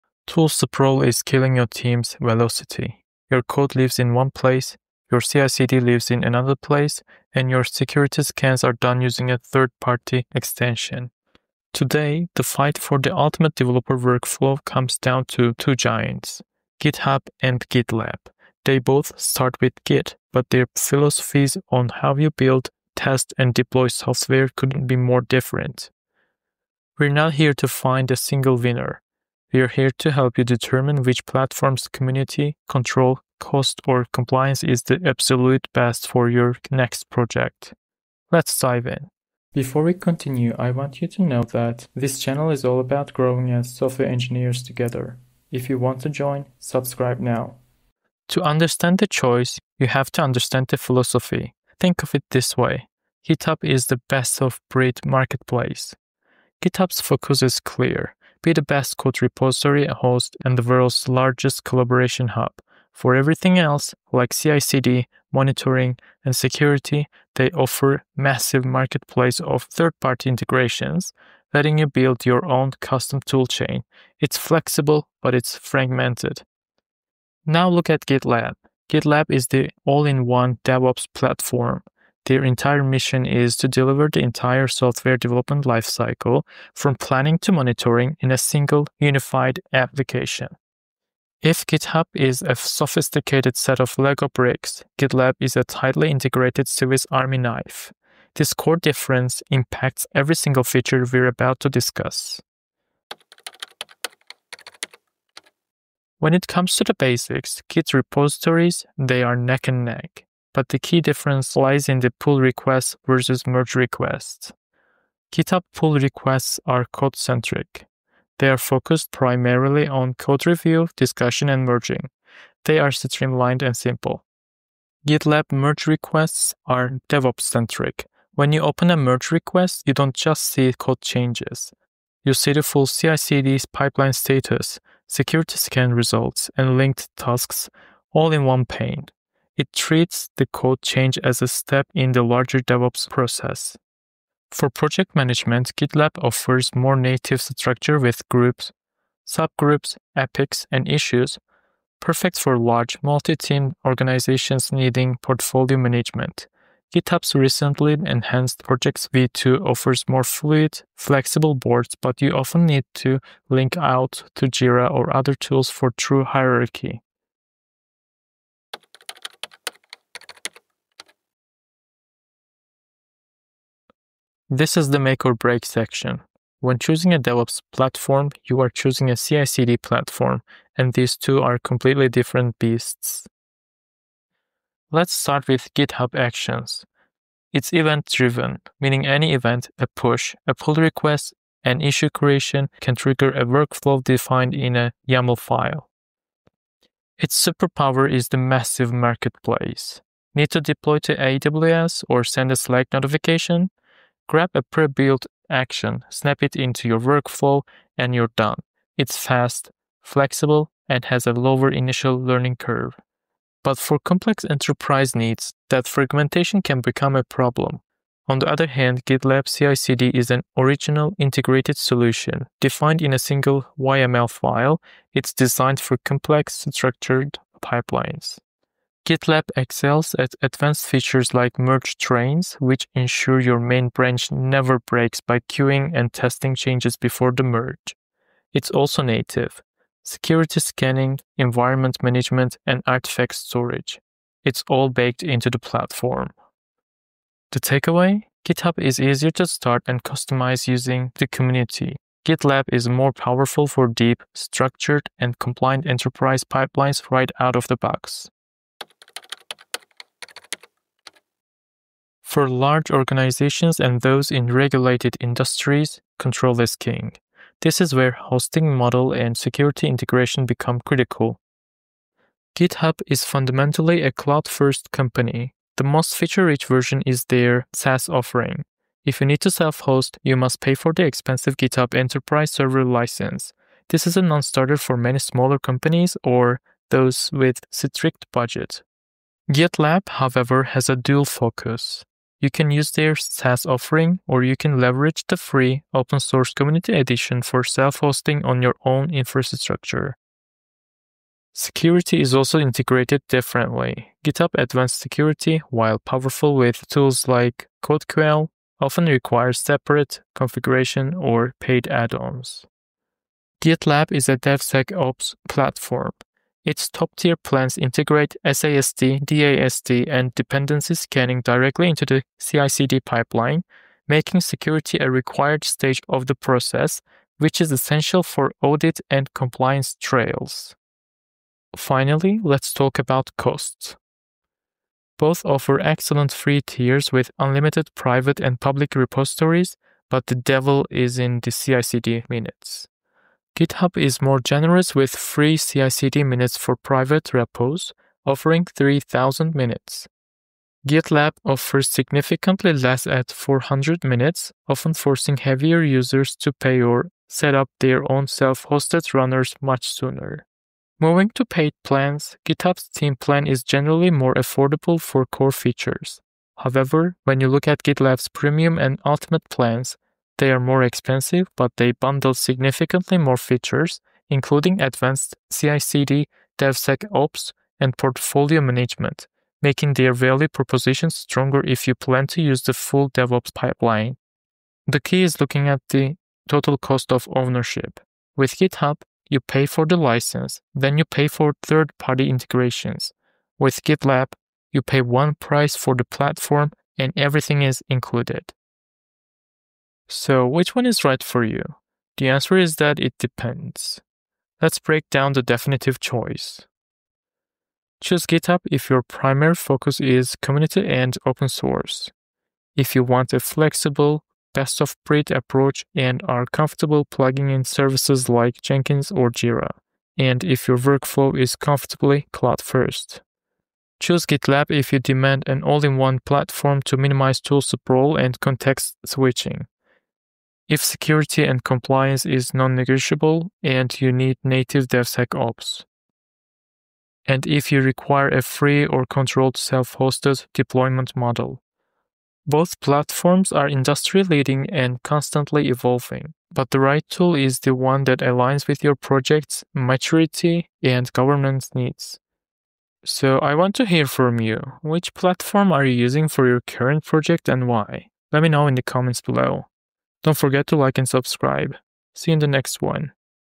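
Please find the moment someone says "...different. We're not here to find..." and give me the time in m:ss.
0:25.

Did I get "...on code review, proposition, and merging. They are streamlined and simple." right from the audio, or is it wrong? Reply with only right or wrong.
wrong.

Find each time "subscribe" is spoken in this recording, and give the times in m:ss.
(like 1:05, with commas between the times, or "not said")
0:46, 7:41.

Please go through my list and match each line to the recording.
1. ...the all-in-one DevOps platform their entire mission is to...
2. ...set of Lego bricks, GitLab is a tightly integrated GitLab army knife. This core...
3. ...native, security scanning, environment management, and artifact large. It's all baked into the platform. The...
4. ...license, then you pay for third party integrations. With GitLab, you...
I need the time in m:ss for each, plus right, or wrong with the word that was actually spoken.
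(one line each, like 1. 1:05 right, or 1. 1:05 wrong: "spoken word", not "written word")
1. 1:19 right
2. 1:33 wrong: "Swiss", not "GitLab"
3. 3:59 wrong: "storage", not "large"
4. 6:29 right.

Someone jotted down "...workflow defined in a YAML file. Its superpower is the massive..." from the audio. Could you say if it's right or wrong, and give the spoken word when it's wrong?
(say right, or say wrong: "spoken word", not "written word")
right.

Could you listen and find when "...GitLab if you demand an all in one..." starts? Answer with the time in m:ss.
7:04.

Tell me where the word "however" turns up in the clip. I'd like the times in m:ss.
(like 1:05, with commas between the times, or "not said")
4:50, 6:06.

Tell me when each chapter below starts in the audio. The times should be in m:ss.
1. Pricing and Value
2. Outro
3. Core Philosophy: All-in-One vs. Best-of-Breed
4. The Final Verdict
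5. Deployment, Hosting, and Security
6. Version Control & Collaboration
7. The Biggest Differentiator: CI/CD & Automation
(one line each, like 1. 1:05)
1. 5:32
2. 7:33
3. 0:48
4. 6:40
5. 4:19
6. 1:43
7. 2:49.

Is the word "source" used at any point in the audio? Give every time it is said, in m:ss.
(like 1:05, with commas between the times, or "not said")
4:56, 6:51.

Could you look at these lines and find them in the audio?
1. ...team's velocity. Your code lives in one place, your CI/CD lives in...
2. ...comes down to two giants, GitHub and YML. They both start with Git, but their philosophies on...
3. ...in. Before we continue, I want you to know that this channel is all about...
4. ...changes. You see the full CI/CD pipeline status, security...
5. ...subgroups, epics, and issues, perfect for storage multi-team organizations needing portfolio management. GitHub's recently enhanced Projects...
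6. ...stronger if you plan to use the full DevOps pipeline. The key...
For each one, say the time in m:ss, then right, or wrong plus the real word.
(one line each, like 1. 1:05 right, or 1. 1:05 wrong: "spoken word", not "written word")
1. 0:01 right
2. 0:14 wrong: "GitLab", not "YML"
3. 0:38 right
4. 2:11 right
5. 2:29 wrong: "large", not "storage"
6. 6:21 right.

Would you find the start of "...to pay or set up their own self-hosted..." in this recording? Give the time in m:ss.
5:56.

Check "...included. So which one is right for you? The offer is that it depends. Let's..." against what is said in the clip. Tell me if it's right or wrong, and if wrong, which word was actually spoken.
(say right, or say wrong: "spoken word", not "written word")
wrong: "answer", not "offer".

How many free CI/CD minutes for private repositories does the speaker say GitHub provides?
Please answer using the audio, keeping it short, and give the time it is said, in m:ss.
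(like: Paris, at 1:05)
3,000, at 5:48.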